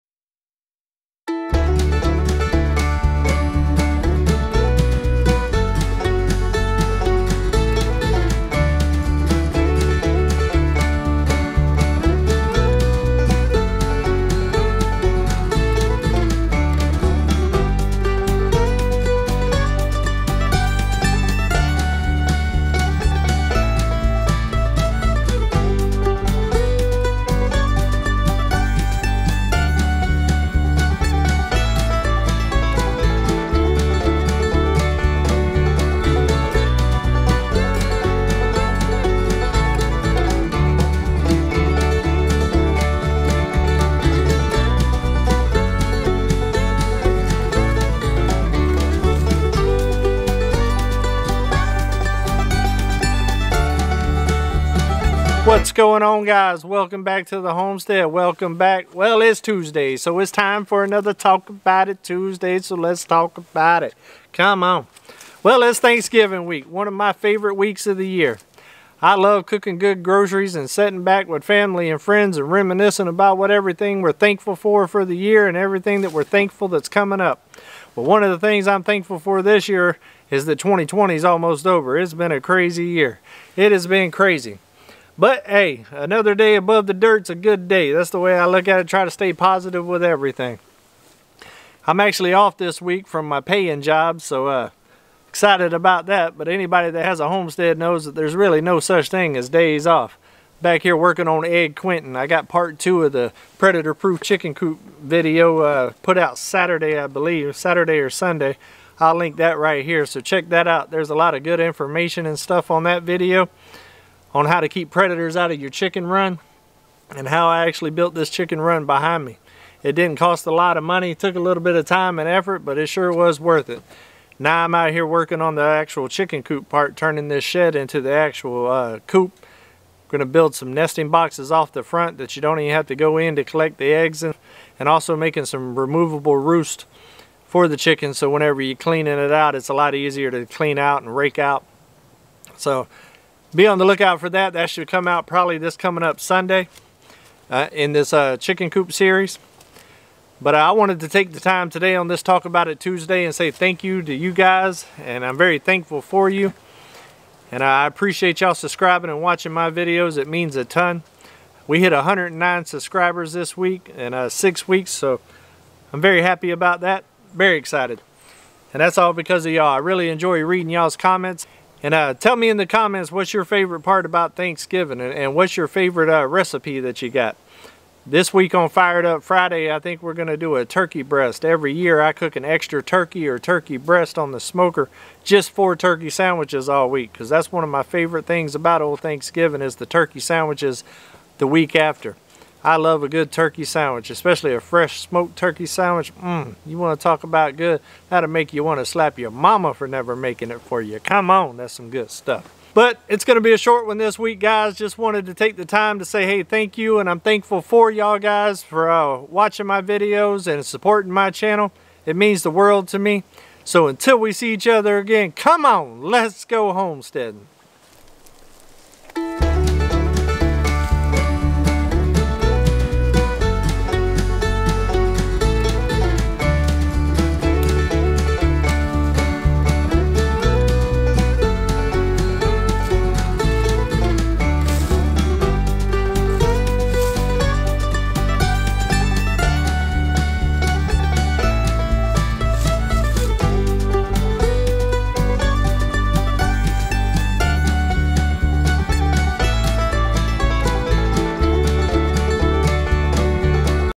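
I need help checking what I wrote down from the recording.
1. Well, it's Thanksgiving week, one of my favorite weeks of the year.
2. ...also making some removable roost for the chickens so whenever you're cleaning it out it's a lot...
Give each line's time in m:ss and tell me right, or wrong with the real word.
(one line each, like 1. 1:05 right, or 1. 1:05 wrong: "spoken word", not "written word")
1. 1:05 right
2. 2:14 right.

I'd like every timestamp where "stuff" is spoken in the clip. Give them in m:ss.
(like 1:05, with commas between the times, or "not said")
1:52, 3:22.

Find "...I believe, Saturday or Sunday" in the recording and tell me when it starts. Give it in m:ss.
1:46.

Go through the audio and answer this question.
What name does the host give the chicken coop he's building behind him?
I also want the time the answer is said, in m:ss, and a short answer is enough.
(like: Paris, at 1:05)
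Egg Quentin, at 1:41.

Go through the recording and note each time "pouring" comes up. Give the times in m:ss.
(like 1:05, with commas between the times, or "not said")
not said.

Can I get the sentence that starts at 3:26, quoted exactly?
And I'm thankful for y'all guys for uh, watching my videos and supporting my channel.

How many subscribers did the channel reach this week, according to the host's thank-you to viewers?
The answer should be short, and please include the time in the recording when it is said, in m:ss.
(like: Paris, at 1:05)
109, at 2:41.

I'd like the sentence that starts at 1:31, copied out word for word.
I'm actually off this week from my paying job, so uh, excited about that.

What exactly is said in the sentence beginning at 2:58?
This week on Fired Up Friday, I think we're going to do a turkey breast.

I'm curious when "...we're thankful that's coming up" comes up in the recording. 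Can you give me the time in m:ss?
1:16.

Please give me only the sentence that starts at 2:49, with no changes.
I really enjoy reading y'all's comments.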